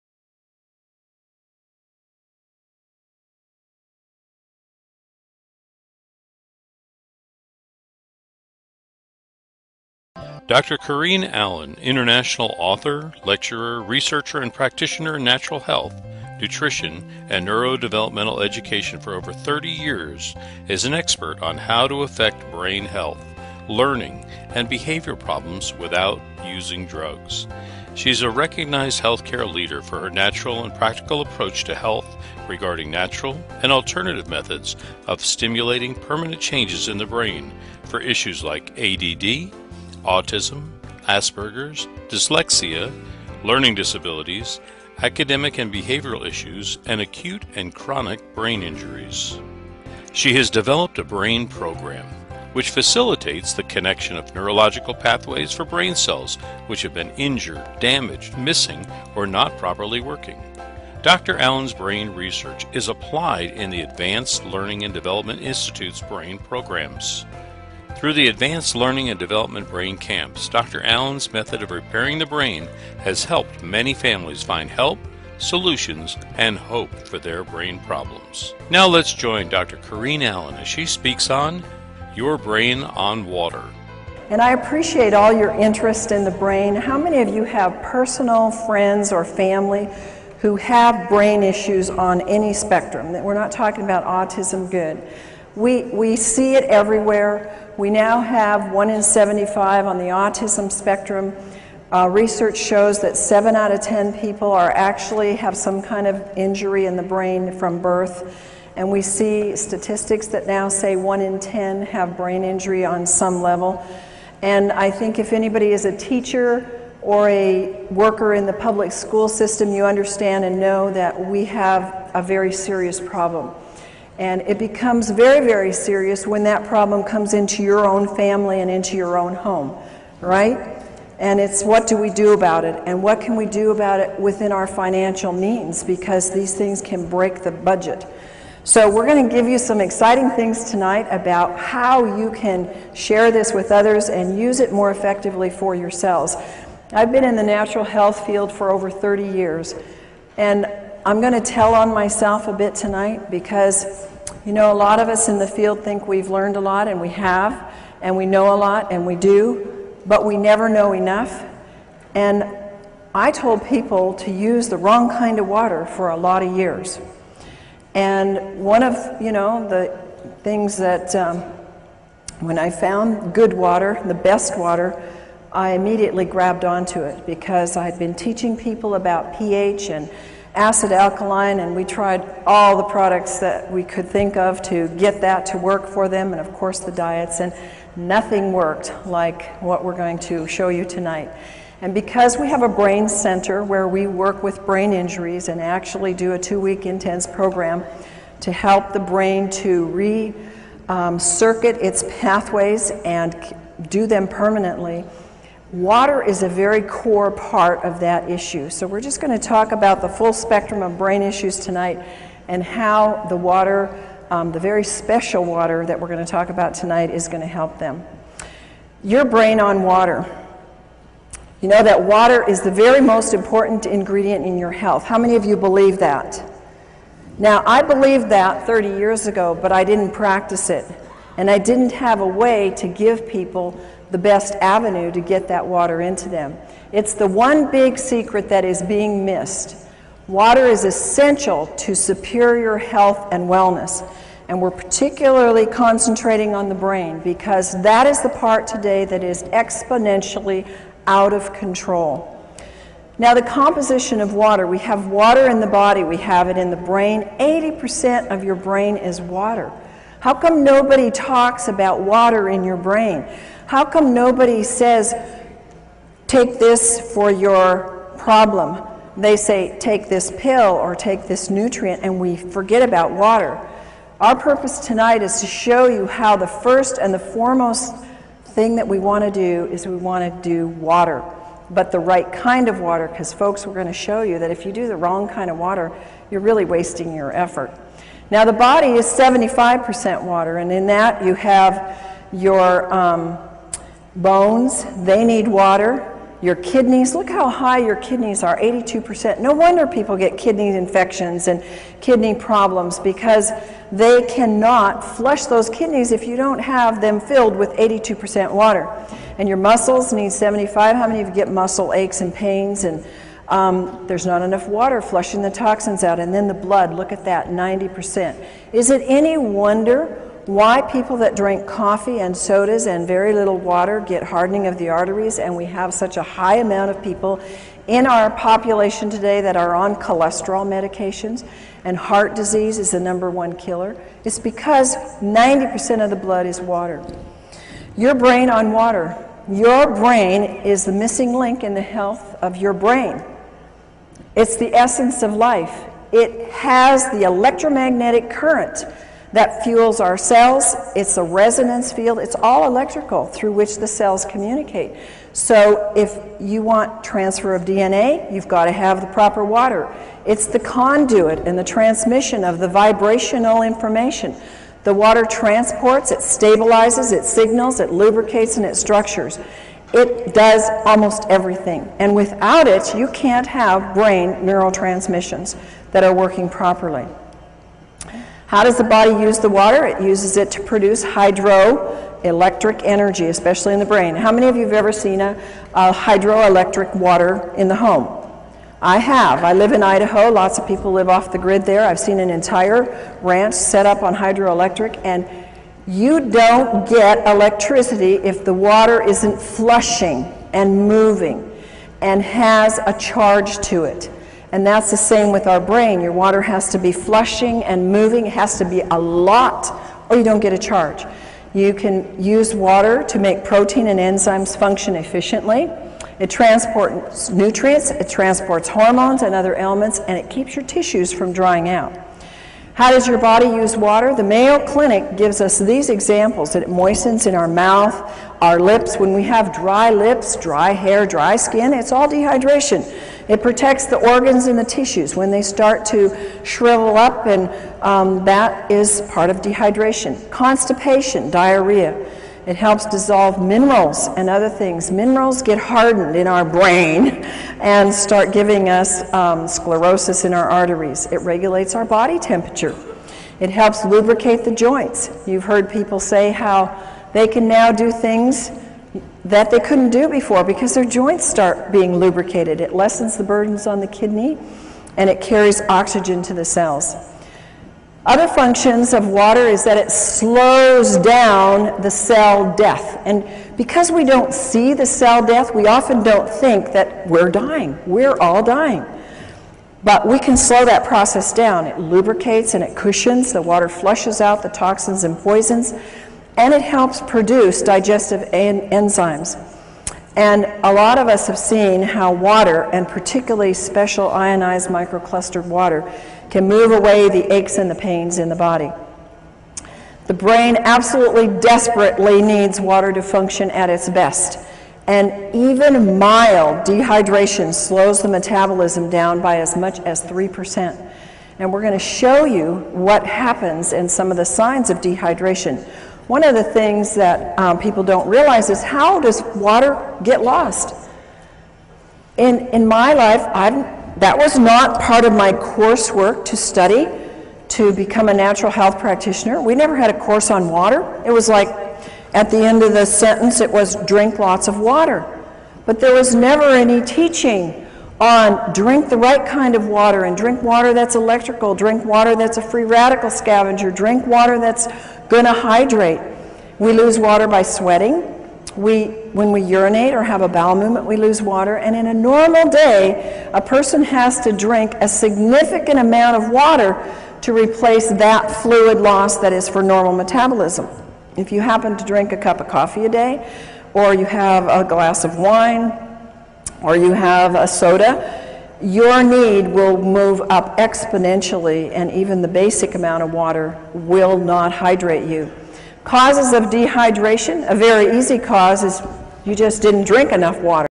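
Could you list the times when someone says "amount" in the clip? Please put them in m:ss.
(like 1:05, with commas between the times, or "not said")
5:26, 9:15, 9:32.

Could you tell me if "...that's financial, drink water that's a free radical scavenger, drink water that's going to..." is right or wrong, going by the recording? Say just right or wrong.
wrong.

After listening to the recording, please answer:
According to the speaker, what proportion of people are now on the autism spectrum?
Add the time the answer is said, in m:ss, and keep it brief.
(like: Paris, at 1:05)
1 in 75, at 1:38.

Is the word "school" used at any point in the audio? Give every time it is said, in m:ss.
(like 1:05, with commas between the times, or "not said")
1:58.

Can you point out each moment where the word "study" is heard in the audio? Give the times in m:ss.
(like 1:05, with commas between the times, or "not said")
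8:46.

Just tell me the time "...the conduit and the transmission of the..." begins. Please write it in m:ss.
6:00.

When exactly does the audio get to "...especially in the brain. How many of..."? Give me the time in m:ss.
6:23.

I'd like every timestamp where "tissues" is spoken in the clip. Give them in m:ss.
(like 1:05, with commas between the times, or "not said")
7:00, 7:14.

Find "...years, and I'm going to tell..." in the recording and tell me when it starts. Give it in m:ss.
2:29.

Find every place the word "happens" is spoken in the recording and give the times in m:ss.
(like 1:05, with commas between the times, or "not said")
8:33, 9:21.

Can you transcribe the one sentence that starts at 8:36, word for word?
One of the things that um, people don't realize is how does water get lost?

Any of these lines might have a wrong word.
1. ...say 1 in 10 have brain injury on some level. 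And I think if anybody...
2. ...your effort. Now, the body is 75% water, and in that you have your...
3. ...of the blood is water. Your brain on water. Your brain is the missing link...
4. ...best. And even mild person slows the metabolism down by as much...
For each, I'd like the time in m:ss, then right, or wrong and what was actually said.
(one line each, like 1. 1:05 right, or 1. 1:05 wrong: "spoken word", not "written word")
1. 1:50 right
2. 4:47 right
3. 5:36 right
4. 8:23 wrong: "dehydration", not "person".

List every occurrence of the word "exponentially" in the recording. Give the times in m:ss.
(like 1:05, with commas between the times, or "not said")
4:09, 9:30.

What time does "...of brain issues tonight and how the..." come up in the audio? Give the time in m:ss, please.
3:30.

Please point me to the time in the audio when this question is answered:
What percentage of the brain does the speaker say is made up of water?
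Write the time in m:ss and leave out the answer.
4:17.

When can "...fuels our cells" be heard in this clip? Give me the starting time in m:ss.
5:49.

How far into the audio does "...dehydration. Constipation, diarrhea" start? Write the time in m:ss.
7:19.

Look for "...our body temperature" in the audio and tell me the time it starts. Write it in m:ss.
7:31.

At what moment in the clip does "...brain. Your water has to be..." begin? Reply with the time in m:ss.
6:45.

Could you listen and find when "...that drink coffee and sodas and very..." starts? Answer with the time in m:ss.
5:21.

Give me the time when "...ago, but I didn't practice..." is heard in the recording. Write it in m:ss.
3:49.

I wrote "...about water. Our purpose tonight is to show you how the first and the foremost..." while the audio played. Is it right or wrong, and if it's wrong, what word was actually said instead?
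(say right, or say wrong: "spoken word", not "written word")
right.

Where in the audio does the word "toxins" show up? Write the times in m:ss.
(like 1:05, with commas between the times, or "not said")
5:15, 8:04.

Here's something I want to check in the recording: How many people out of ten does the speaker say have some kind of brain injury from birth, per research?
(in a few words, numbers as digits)
7.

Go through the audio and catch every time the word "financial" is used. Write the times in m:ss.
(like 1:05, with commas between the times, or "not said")
2:14.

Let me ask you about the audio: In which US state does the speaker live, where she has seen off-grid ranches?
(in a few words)
Idaho.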